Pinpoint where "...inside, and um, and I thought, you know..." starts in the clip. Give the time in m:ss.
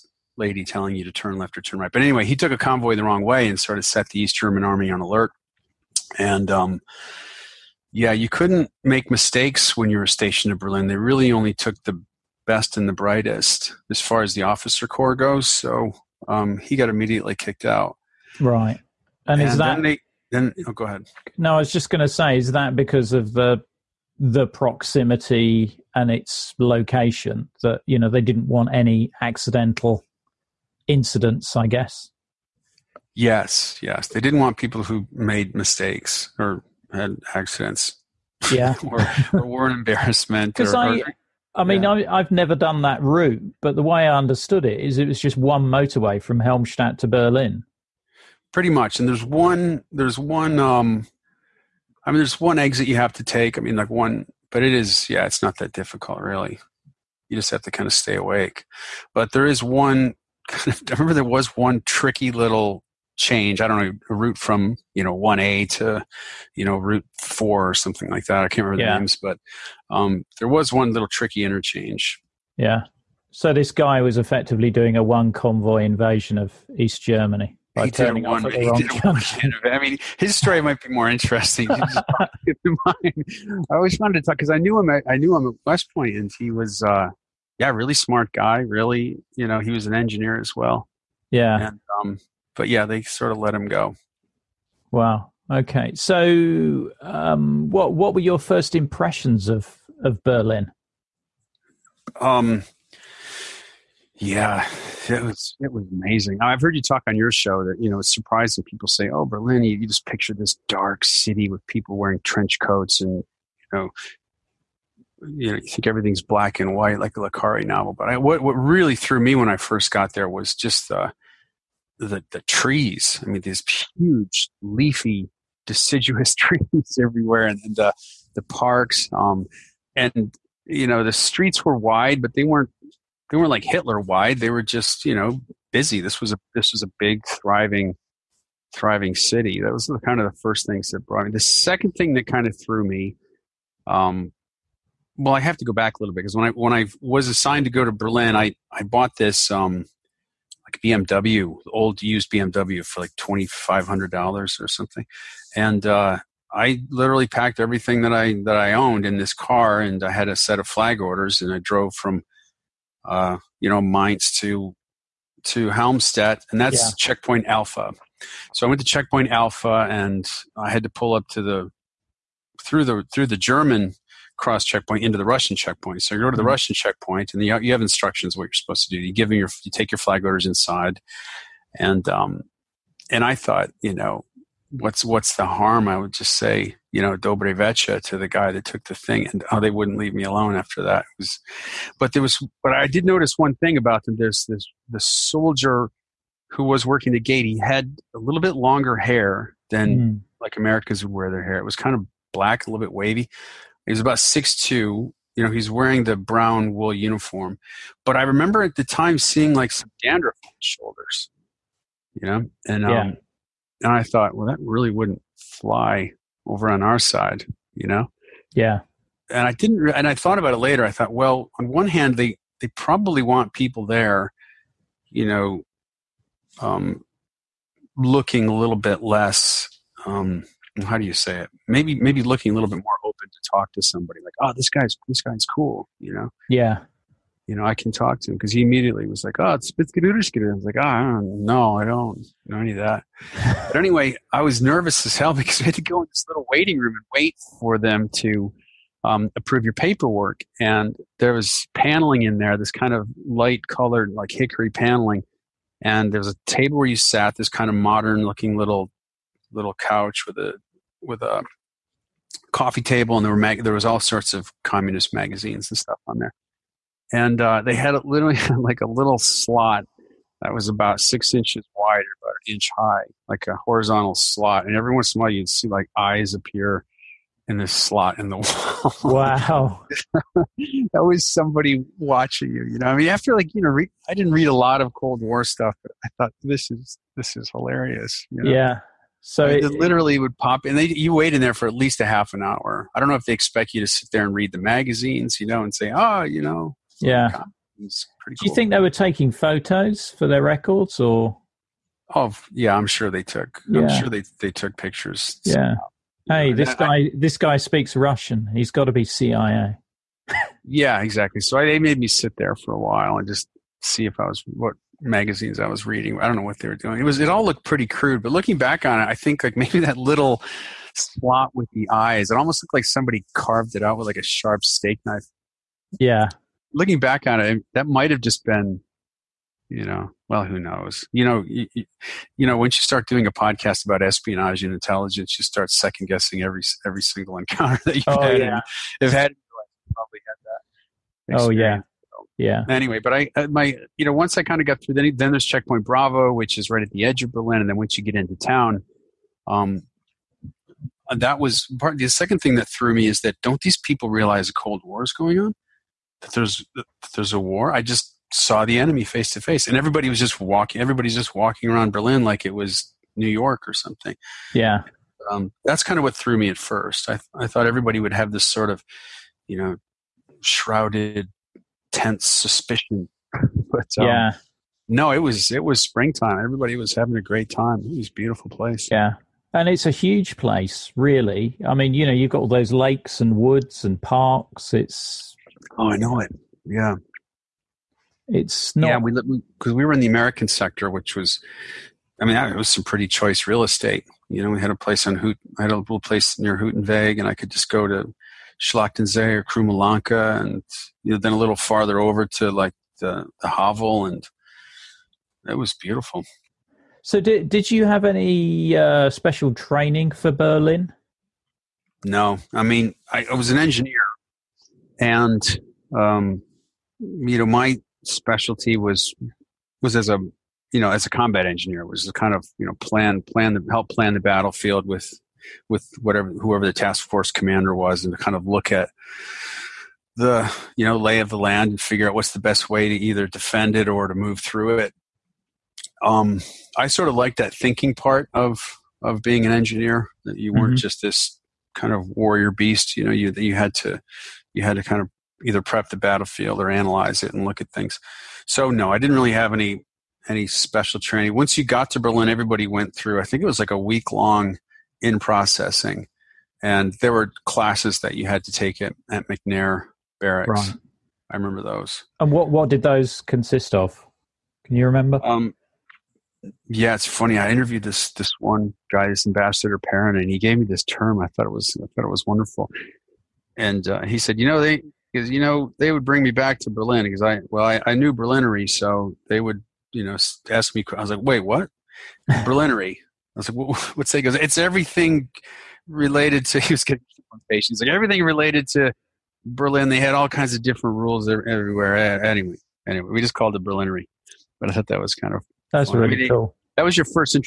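3:00.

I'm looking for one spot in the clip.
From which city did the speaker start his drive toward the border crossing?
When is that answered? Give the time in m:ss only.
2:43.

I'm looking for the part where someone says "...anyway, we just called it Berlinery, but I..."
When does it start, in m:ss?
8:12.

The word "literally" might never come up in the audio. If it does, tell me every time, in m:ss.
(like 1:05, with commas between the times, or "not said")
2:36, 4:28, 4:49.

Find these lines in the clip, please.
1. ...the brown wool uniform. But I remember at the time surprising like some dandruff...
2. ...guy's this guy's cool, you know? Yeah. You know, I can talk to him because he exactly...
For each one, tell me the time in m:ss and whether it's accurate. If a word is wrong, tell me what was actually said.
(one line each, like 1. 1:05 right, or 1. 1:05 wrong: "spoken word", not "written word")
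1. 3:26 wrong: "seeing", not "surprising"
2. 3:54 wrong: "immediately", not "exactly".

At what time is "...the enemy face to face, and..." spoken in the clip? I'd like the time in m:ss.
5:58.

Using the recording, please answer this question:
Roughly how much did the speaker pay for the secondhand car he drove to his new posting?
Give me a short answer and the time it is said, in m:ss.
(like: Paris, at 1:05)
$2,500, at 2:33.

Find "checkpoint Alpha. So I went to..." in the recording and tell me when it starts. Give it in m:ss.
2:46.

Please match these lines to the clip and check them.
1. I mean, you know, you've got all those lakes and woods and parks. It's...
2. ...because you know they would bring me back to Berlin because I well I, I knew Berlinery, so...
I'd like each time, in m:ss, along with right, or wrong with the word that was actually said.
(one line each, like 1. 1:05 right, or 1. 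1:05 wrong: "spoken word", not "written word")
1. 6:21 right
2. 7:55 right.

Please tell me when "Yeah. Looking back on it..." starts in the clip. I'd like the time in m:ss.
5:25.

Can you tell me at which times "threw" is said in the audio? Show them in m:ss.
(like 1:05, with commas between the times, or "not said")
1:58, 2:22, 5:52, 6:06.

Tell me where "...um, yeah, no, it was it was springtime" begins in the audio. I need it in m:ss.
6:13.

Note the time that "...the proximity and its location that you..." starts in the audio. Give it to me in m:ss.
0:24.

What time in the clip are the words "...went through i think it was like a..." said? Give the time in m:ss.
7:32.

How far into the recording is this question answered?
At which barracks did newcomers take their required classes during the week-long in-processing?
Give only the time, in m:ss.
7:39.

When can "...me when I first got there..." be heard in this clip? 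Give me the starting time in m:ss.
1:59.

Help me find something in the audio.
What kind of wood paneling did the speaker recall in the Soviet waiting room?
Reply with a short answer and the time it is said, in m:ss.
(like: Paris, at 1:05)
Hickory, at 4:14.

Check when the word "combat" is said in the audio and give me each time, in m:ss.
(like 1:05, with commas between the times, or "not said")
7:01.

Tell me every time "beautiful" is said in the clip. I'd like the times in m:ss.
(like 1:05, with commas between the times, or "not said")
6:18, 6:45.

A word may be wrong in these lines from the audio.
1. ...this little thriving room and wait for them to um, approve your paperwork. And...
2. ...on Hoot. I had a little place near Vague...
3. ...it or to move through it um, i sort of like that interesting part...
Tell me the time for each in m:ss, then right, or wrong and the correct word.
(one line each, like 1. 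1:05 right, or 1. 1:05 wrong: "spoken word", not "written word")
1. 4:06 wrong: "waiting", not "thriving"
2. 6:35 right
3. 7:13 wrong: "thinking", not "interesting".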